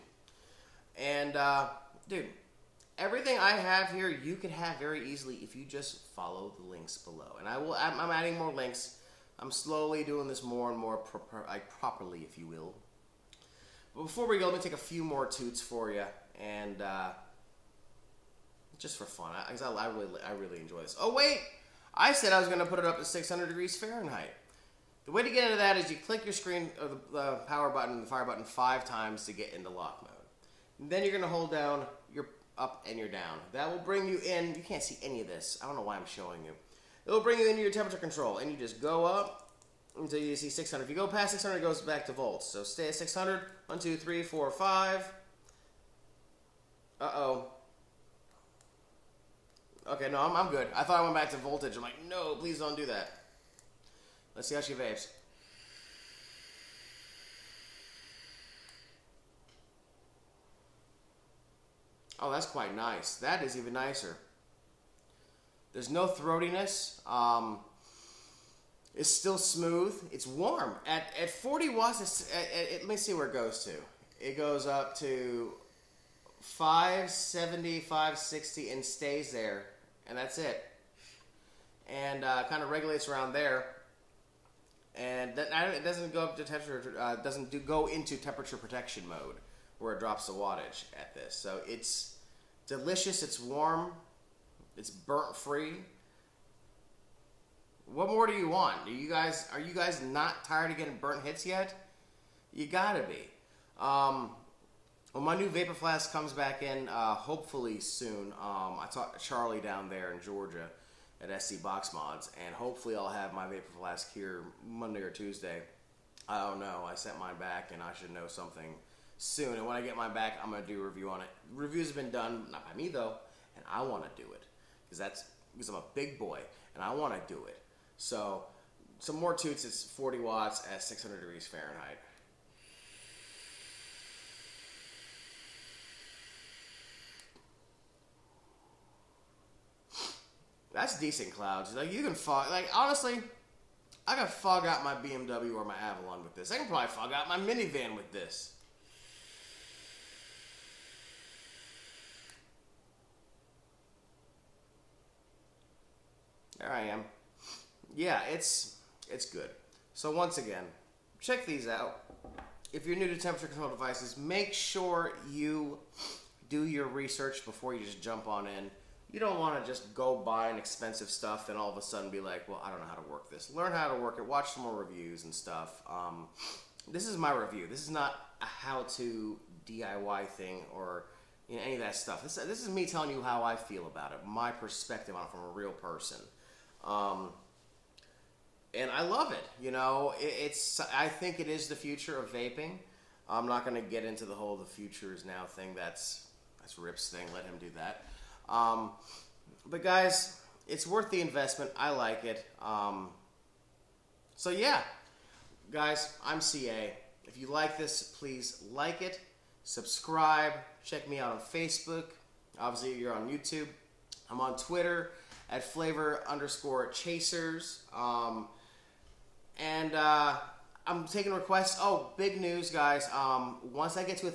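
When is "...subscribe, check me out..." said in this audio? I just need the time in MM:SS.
03:29.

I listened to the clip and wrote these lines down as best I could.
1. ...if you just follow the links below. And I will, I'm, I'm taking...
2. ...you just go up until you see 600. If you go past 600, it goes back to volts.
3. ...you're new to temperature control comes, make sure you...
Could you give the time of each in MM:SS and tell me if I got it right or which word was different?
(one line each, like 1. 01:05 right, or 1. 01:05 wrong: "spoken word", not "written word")
1. 00:05 wrong: "adding", not "taking"
2. 00:38 right
3. 02:42 wrong: "devices", not "comes".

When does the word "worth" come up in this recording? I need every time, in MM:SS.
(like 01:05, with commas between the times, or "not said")
03:20.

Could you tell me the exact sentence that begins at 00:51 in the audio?
I'm like, no, please don't do that.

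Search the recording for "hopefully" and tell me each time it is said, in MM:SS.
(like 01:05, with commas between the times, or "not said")
01:47, 01:52.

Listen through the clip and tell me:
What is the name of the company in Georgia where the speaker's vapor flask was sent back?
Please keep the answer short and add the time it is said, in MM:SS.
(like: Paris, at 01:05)
SC Box Mods, at 01:51.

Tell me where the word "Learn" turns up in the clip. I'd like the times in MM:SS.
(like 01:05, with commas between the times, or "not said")
02:53.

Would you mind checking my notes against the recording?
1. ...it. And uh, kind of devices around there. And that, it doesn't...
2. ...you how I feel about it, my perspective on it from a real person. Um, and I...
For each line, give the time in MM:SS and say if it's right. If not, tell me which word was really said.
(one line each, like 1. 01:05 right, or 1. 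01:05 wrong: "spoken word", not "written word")
1. 01:20 wrong: "regulates", not "devices"
2. 03:03 right.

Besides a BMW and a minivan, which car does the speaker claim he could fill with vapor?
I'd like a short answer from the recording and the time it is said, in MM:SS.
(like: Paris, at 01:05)
Avalon, at 02:25.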